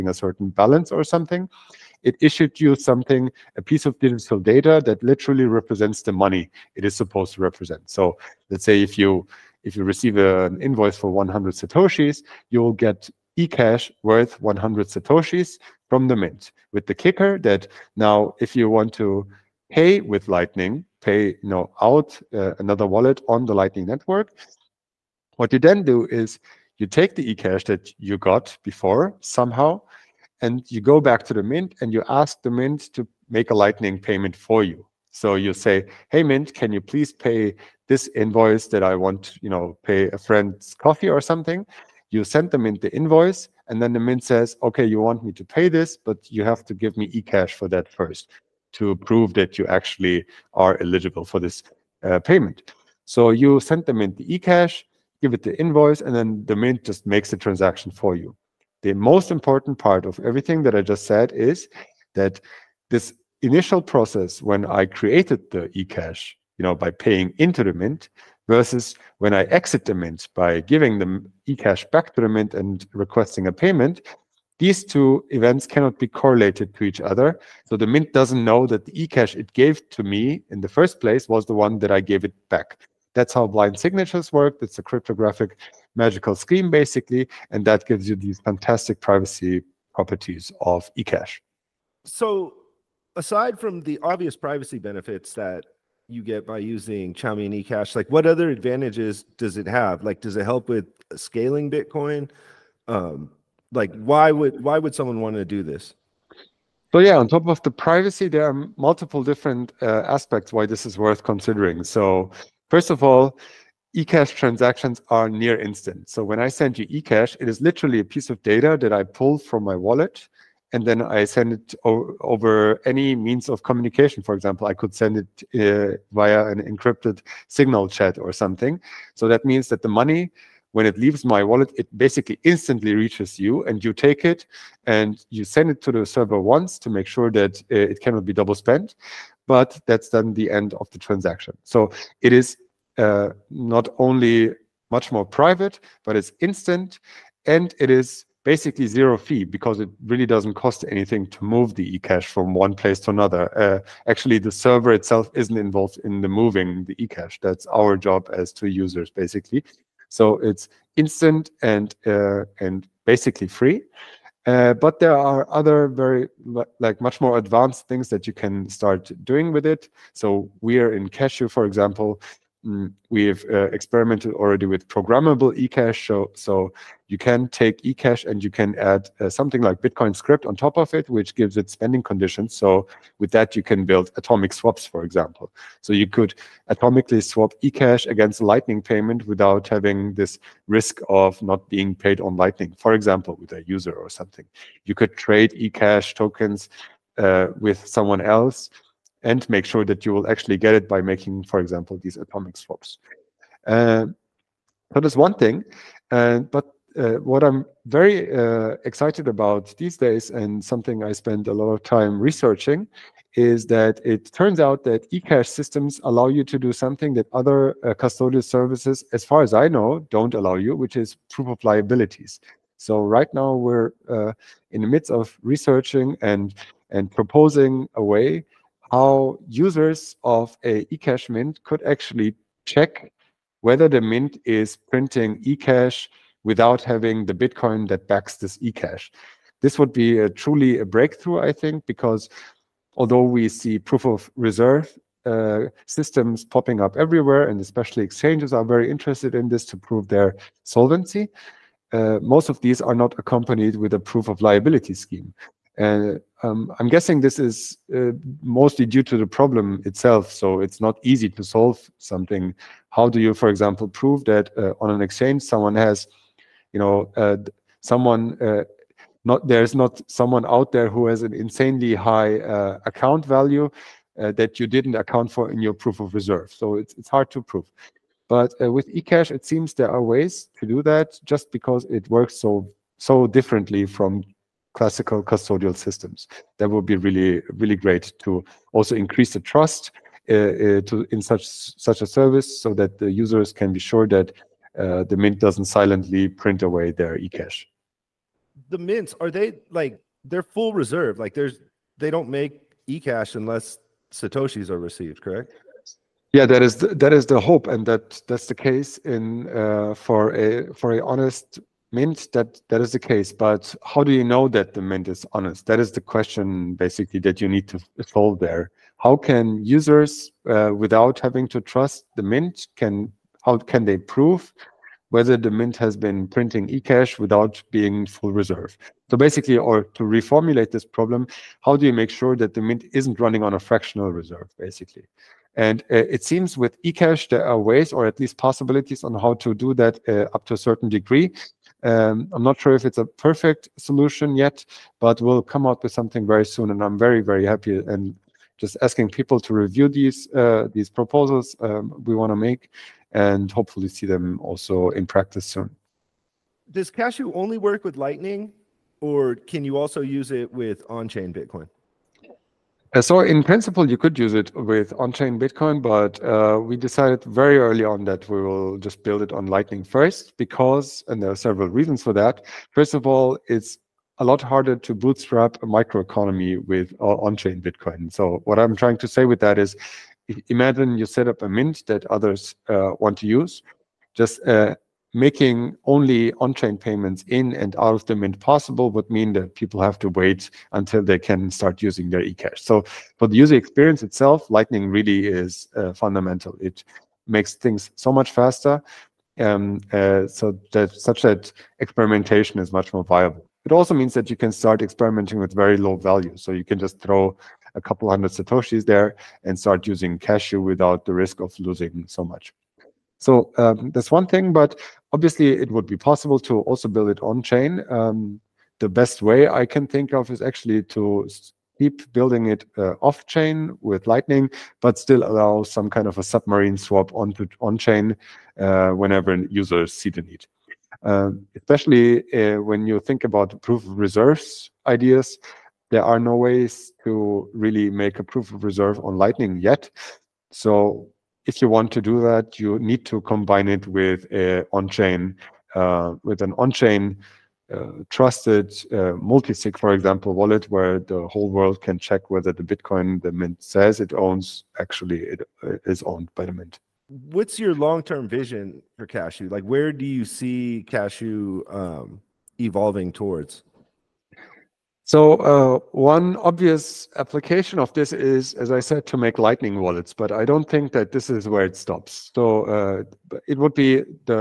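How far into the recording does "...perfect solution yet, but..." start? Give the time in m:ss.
5:43.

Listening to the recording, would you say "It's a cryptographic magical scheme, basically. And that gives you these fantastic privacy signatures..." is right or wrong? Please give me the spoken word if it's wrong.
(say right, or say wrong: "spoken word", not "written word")
wrong: "properties", not "signatures".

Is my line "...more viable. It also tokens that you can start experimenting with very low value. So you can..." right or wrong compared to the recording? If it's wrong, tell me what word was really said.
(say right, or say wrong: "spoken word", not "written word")
wrong: "means", not "tokens".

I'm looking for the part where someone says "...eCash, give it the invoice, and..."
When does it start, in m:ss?
0:54.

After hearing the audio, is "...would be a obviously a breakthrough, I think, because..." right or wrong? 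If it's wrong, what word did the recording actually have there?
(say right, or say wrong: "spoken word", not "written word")
wrong: "truly", not "obviously".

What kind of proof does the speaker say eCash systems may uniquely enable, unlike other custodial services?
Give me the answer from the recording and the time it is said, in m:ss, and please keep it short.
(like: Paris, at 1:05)
Proof of liabilities, at 3:41.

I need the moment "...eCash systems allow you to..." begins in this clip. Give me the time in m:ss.
3:35.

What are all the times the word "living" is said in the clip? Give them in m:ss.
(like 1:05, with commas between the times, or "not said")
not said.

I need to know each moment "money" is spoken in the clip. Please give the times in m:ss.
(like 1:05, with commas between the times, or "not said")
0:06, 2:09.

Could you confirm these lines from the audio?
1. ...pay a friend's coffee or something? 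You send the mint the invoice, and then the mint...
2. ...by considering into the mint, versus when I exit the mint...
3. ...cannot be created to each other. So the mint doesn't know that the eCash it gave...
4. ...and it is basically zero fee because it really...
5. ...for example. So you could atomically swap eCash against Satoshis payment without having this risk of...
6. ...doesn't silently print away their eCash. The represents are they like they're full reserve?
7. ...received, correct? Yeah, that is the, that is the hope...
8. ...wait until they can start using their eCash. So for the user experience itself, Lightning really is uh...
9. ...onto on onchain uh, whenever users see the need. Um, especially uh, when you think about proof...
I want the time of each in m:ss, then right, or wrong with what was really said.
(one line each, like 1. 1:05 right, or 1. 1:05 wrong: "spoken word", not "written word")
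1. 0:39 right
2. 1:06 wrong: "paying", not "considering"
3. 1:15 wrong: "correlated", not "created"
4. 2:27 right
5. 3:04 wrong: "Lightning", not "Satoshis"
6. 4:55 wrong: "mints", not "represents"
7. 5:04 right
8. 6:30 right
9. 7:07 wrong: "chain", not "onchain".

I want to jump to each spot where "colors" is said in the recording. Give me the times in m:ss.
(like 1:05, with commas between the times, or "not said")
not said.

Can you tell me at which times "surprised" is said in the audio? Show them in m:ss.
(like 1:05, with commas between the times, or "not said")
not said.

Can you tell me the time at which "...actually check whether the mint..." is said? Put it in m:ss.
3:51.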